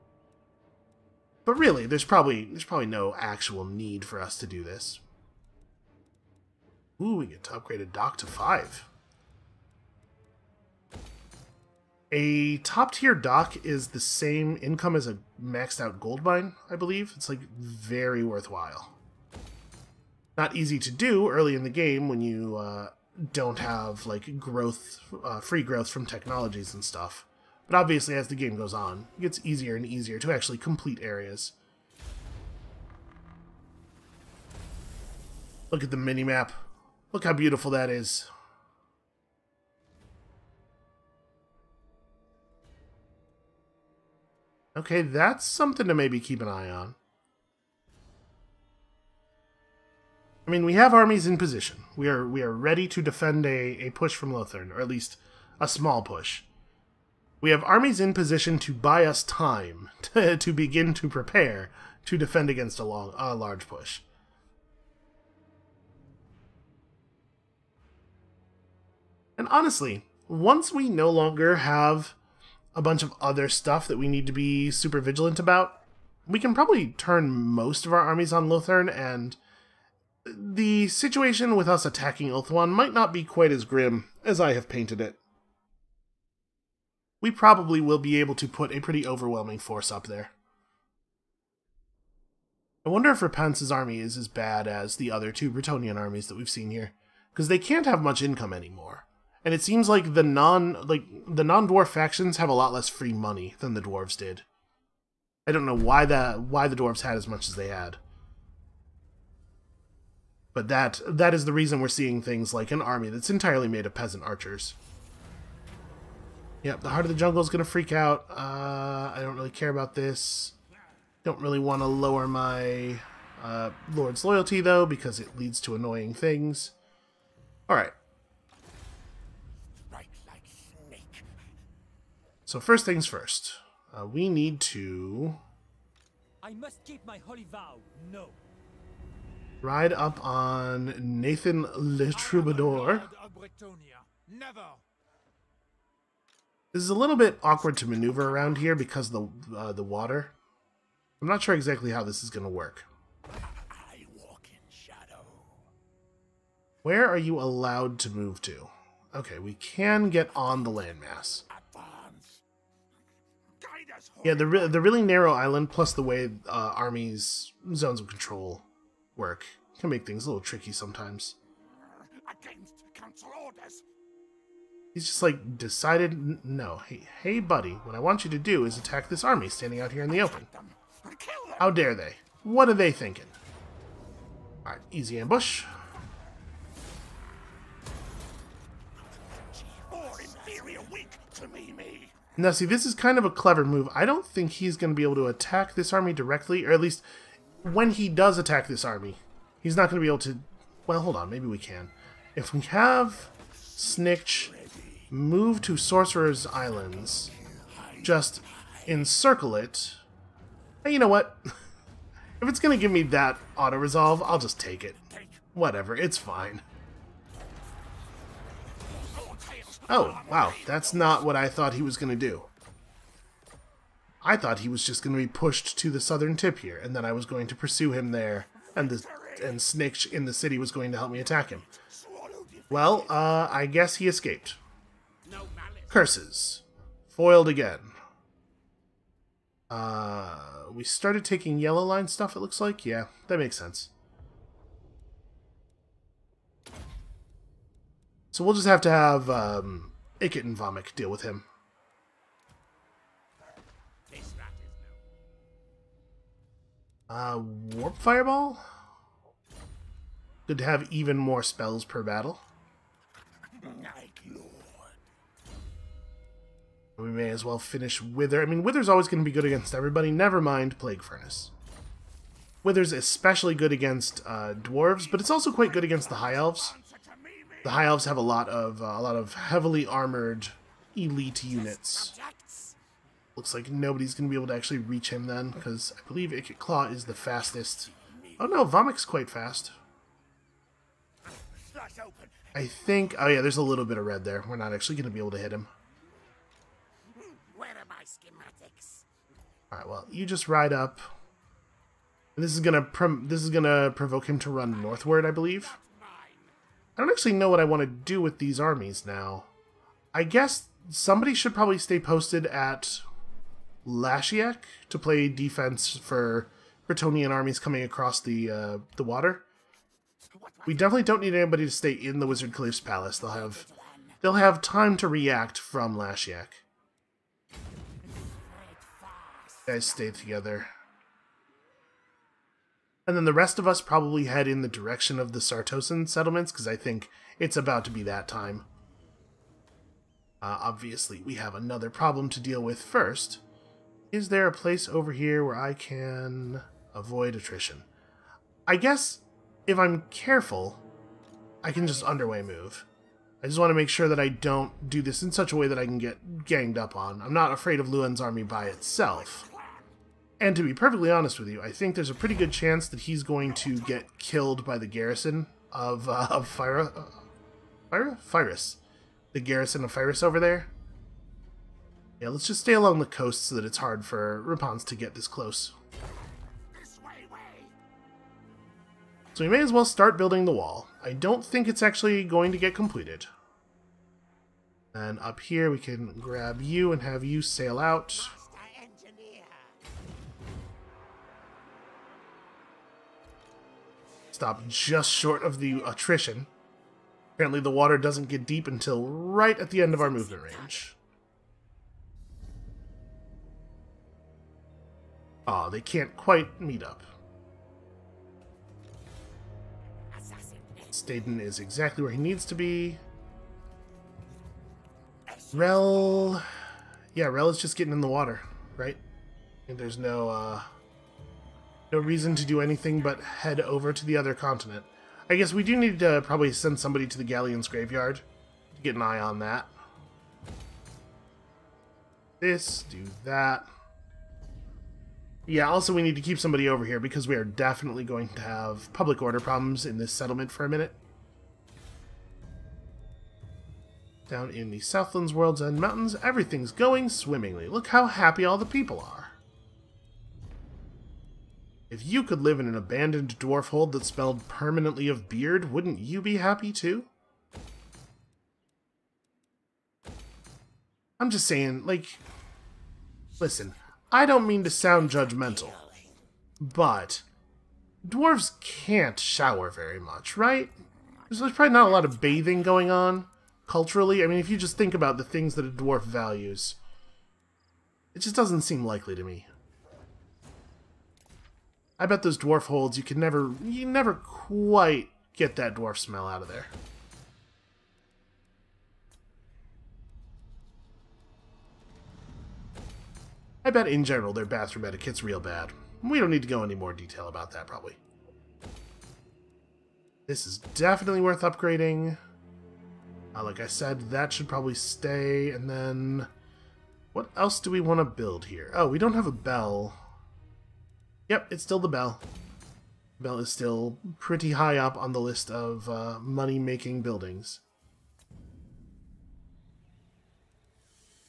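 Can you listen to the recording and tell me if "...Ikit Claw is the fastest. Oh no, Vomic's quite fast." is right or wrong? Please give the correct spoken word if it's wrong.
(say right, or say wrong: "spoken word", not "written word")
right.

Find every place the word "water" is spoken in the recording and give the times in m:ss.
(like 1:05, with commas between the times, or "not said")
2:29, 5:19, 6:37, 6:58.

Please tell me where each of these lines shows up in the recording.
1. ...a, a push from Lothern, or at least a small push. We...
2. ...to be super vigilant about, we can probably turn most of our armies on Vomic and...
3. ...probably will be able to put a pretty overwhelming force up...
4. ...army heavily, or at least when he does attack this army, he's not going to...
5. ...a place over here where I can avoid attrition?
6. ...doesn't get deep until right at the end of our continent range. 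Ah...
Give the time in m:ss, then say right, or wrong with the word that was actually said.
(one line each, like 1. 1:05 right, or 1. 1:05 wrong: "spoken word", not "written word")
1. 0:53 right
2. 1:14 wrong: "Lothern", not "Vomic"
3. 1:27 right
4. 3:15 wrong: "directly", not "heavily"
5. 5:44 right
6. 6:37 wrong: "movement", not "continent".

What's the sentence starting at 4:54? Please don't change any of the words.
We're not actually going to be able to hit him.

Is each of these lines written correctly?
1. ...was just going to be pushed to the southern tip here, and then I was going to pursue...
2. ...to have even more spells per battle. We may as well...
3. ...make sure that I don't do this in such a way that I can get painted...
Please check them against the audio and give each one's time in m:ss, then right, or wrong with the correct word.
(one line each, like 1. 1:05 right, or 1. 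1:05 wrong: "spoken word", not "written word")
1. 3:44 right
2. 4:20 right
3. 5:53 wrong: "ganged", not "painted".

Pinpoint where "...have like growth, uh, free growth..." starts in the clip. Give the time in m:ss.
0:23.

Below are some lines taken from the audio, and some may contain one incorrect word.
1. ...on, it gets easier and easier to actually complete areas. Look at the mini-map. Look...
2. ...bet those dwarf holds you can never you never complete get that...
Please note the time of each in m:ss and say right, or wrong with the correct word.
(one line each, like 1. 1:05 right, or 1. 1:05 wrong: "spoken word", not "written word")
1. 0:28 right
2. 8:02 wrong: "quite", not "complete".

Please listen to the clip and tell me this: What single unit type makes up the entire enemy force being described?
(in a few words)
peasant archers.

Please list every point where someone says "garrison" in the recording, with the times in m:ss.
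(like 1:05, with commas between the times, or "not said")
6:04, 6:09.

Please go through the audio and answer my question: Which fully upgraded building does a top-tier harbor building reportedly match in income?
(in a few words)
gold mine.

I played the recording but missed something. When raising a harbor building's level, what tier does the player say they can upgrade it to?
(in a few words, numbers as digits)
5.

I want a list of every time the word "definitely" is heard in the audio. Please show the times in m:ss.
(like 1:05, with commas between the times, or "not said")
5:20, 7:17, 8:20.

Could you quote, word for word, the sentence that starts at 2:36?
Where are you allowed to move to?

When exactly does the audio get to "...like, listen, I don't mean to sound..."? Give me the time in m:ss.
7:41.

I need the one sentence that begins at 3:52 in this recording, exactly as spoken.
Well, uh, I guess he escaped.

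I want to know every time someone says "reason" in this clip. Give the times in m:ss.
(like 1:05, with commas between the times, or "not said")
1:51, 7:01.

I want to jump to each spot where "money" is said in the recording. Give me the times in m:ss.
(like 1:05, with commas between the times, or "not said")
1:43, 8:36.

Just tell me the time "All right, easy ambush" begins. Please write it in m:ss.
3:04.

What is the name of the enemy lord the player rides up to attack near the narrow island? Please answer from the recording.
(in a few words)
Nathan Le Troubadour.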